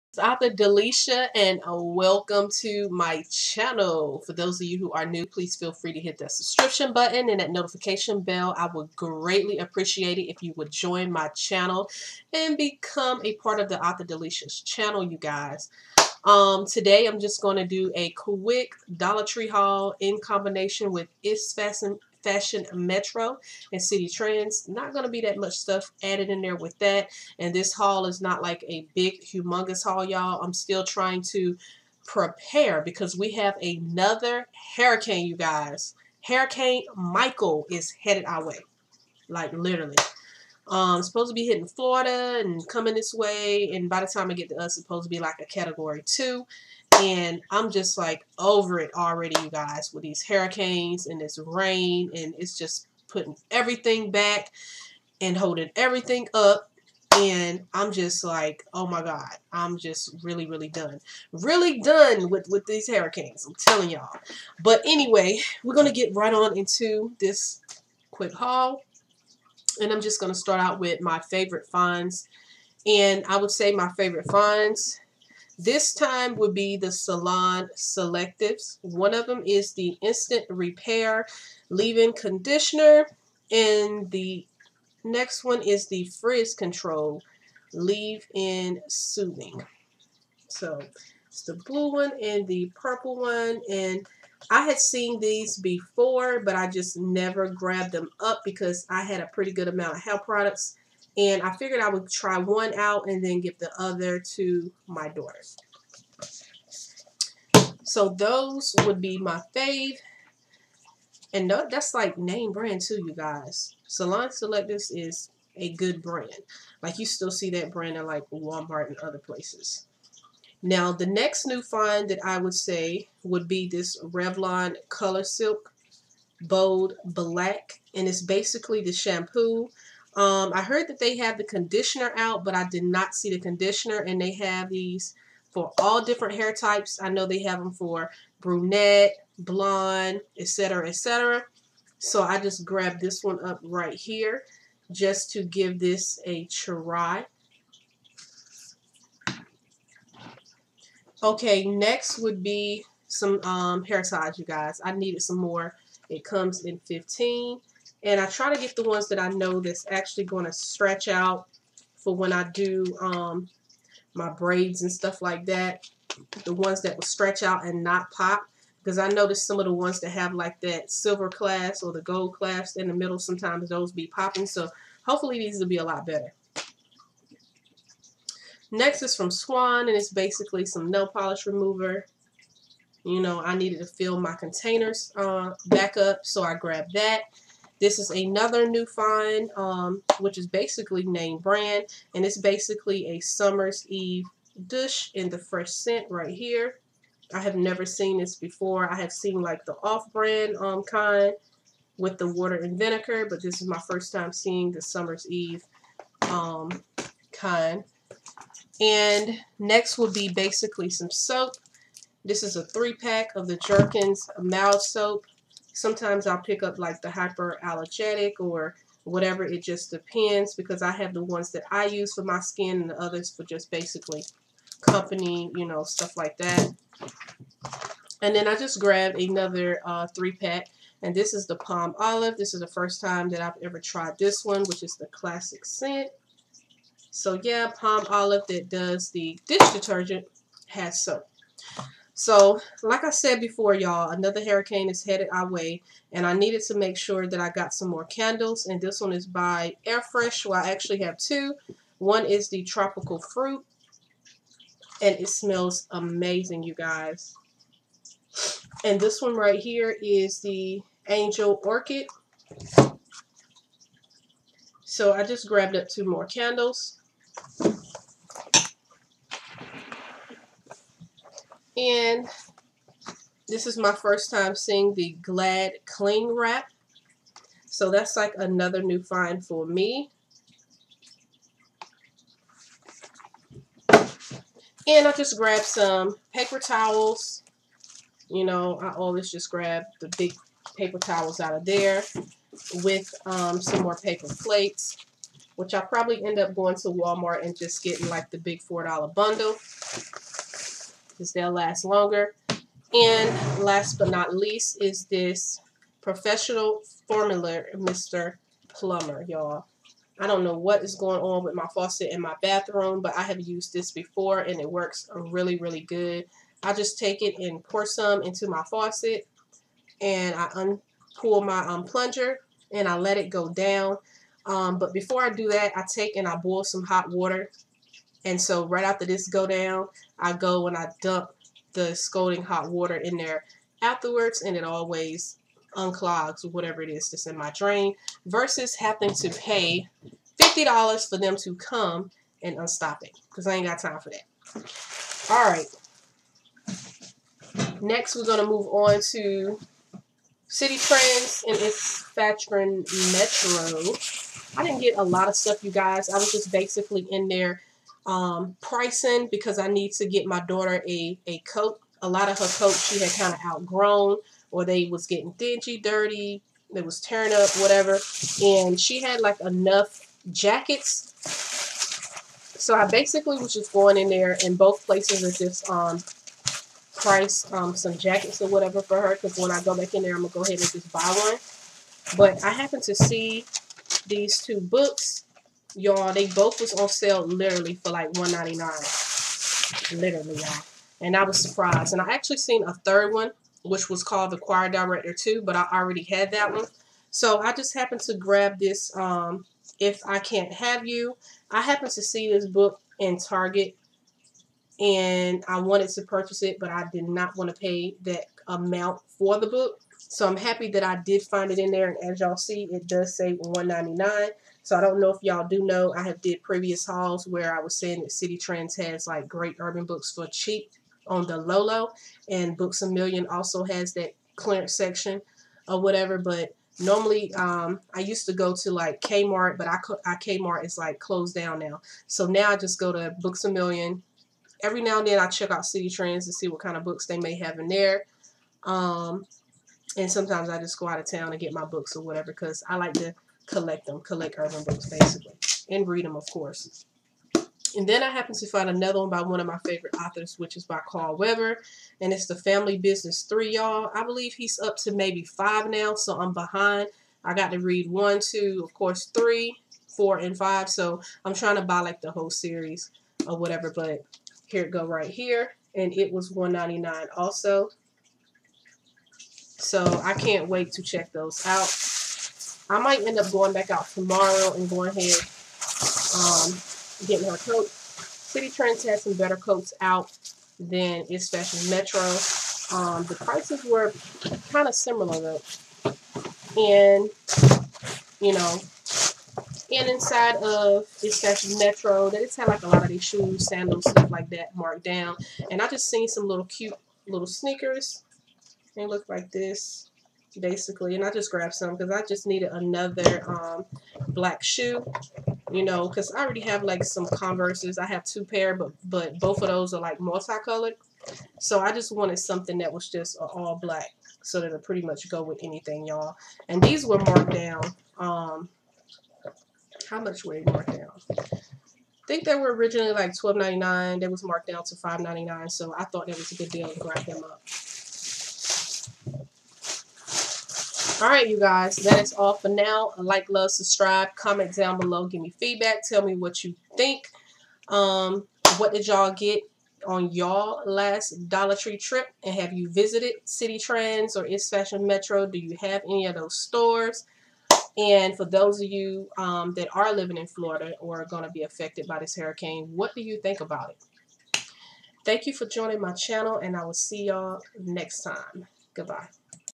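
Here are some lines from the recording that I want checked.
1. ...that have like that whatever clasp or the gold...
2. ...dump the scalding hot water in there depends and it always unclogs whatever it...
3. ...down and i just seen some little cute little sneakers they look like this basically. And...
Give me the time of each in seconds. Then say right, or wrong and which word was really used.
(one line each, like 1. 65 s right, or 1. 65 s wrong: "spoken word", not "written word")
1. 169 s wrong: "silver", not "whatever"
2. 331 s wrong: "afterwards", not "depends"
3. 494 s right.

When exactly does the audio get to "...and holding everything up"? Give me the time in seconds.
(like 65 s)
55 s.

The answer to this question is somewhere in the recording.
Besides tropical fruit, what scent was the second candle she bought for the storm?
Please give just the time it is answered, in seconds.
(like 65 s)
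261 s.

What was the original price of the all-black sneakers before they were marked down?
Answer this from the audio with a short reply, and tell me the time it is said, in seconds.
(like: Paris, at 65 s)
$12.99, at 523 s.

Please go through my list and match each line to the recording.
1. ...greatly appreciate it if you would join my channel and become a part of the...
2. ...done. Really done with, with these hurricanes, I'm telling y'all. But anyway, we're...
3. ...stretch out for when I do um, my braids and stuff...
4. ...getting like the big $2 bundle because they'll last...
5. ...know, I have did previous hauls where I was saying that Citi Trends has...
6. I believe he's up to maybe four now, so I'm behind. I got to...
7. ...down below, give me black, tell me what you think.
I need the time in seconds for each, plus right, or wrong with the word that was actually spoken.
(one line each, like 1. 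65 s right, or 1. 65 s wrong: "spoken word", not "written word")
1. 8 s right
2. 60 s right
3. 160 s right
4. 297 s wrong: "4", not "2"
5. 415 s right
6. 453 s wrong: "five", not "four"
7. 534 s wrong: "feedback", not "black".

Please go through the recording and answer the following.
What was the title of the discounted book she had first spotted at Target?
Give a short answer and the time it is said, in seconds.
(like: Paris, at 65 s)
If I Can't Have You, at 399 s.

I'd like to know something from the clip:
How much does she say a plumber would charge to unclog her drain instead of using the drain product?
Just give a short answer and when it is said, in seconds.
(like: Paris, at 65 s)
$50, at 340 s.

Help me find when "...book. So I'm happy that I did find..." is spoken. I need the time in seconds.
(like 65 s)
409 s.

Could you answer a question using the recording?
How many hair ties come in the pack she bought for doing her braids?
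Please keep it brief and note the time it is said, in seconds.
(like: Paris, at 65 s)
15, at 156 s.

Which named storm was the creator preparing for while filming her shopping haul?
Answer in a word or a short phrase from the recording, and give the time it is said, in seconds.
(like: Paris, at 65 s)
Hurricane Michael, at 36 s.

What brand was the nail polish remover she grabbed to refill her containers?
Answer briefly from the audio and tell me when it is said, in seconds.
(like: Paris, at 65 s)
Swan, at 179 s.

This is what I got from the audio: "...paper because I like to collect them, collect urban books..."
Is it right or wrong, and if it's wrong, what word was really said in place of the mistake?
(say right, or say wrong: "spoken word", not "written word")
wrong: "whatever", not "paper".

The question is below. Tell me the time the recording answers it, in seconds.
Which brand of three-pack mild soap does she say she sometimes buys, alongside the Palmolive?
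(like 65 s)
213 s.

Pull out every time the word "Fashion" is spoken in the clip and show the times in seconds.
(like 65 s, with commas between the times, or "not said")
22 s, 352 s, 544 s.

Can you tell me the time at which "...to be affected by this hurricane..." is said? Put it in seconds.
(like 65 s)
551 s.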